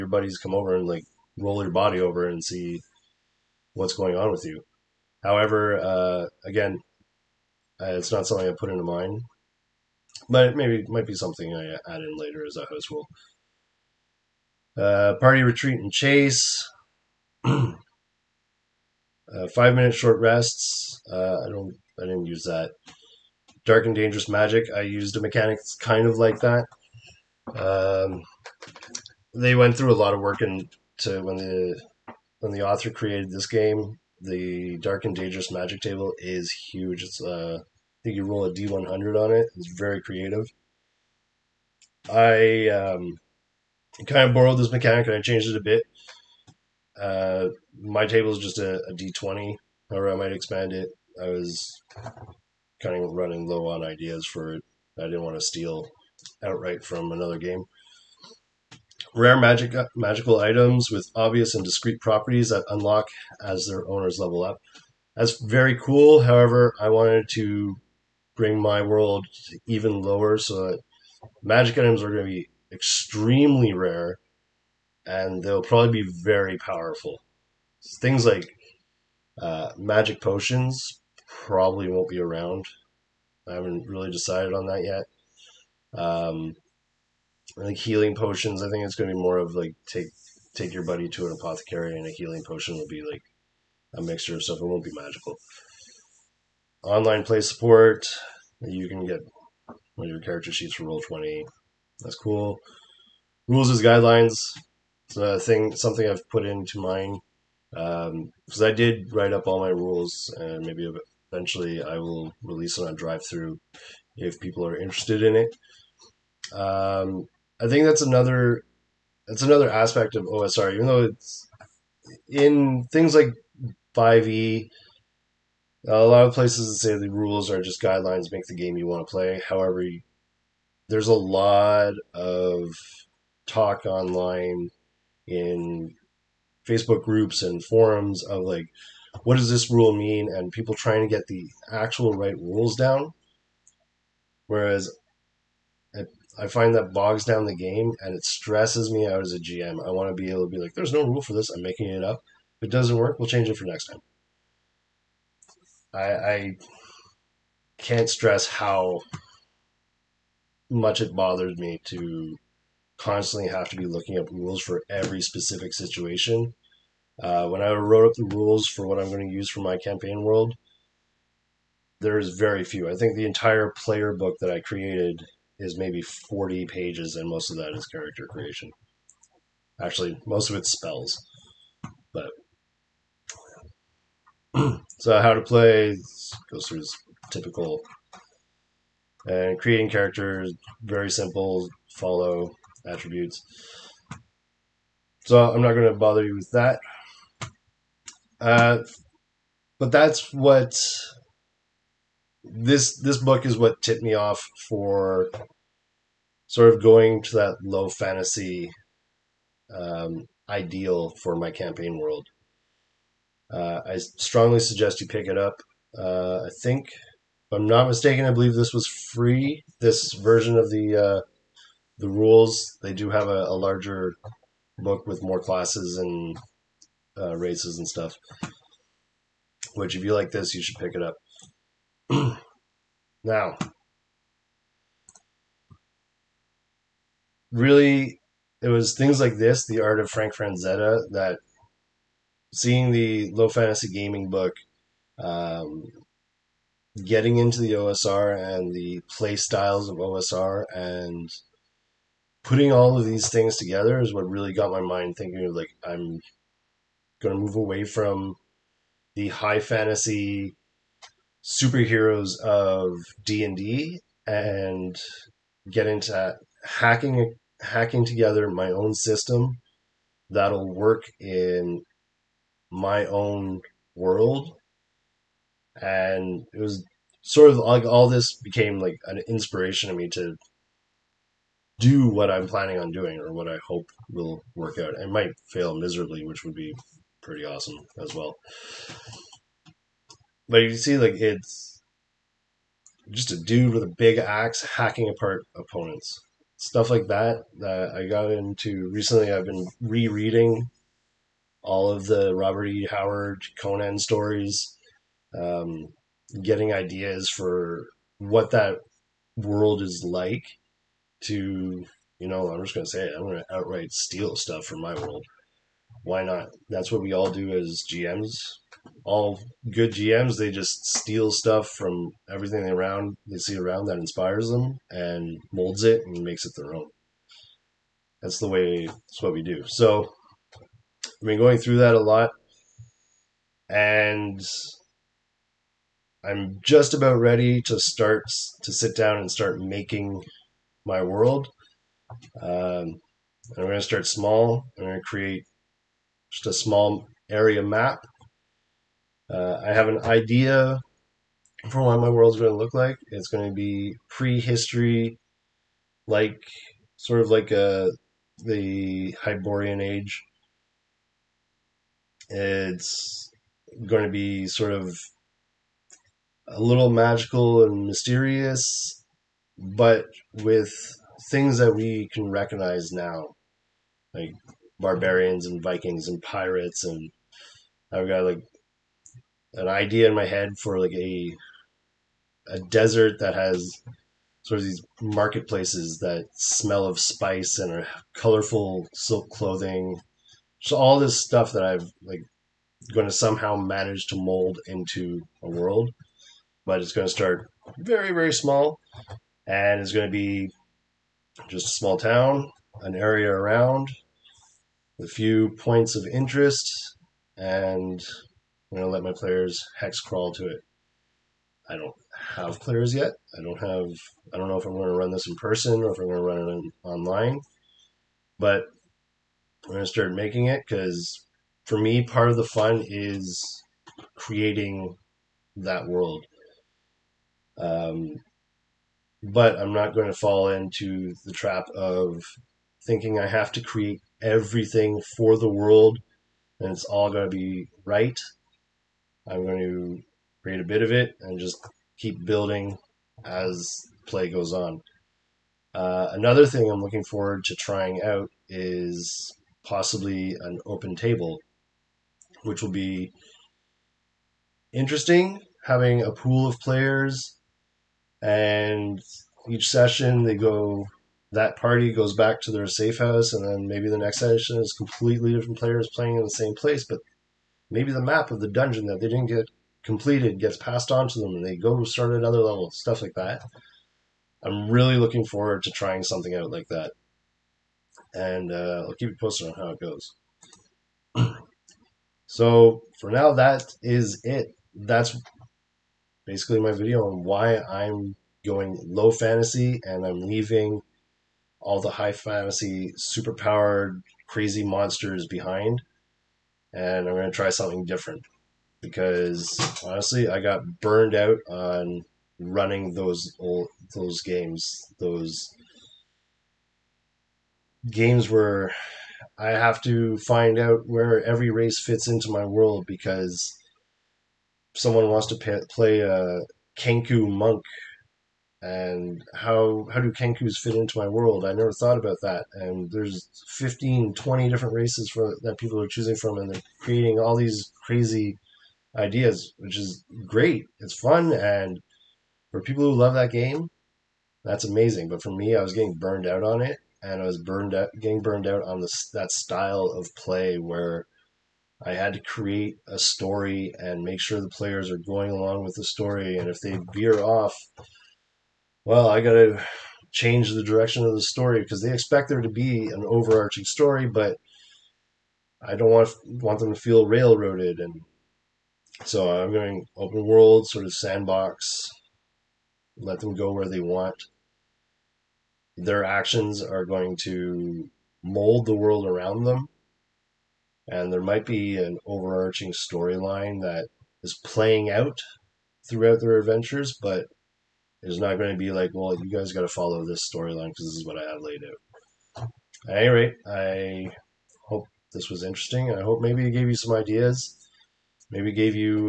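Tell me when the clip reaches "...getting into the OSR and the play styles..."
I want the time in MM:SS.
04:07.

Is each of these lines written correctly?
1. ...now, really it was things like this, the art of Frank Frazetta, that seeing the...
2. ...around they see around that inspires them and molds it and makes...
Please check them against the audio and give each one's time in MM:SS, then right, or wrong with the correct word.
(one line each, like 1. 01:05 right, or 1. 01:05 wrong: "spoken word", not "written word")
1. 03:53 right
2. 05:22 right.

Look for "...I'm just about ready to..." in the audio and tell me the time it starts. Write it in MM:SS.
05:36.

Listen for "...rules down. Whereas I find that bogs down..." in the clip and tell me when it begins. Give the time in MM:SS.
02:22.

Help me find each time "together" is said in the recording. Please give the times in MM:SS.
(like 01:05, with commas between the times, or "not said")
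04:13, 04:28.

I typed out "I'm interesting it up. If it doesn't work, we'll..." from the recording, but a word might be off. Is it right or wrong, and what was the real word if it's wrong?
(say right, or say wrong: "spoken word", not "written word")
wrong: "making", not "interesting".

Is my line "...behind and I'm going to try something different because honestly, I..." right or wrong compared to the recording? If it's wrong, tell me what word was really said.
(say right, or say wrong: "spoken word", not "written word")
right.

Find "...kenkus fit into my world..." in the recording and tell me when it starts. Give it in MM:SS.
08:40.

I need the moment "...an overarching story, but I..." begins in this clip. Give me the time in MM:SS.
09:12.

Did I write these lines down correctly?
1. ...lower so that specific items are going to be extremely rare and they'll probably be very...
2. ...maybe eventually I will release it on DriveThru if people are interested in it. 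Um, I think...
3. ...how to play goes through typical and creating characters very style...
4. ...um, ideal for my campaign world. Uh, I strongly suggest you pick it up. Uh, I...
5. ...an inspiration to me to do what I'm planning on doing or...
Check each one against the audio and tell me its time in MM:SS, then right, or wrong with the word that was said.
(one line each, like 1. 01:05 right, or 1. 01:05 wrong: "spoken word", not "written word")
1. 01:10 wrong: "magic", not "specific"
2. 01:50 right
3. 03:05 wrong: "simple", not "style"
4. 03:29 right
5. 04:39 right.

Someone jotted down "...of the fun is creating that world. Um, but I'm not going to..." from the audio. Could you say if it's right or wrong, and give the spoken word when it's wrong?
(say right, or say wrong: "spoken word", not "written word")
right.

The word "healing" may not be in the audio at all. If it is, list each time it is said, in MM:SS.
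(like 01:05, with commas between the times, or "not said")
01:27, 01:32.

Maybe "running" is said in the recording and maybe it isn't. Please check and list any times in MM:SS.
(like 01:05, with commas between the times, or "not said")
00:53, 08:22.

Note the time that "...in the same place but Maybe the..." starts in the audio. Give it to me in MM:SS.
07:46.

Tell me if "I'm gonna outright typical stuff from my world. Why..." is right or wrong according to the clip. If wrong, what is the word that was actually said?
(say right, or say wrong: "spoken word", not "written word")
wrong: "steal", not "typical".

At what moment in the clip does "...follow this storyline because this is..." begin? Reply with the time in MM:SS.
09:39.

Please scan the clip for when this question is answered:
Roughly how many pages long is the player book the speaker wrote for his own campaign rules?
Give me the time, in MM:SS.
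02:56.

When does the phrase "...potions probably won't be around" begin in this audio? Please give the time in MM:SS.
01:20.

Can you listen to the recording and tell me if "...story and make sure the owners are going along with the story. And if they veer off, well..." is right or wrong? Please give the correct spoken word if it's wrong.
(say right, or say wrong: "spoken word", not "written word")
wrong: "players", not "owners".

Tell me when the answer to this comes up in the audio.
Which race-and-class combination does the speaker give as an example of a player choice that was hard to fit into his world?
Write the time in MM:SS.
08:36.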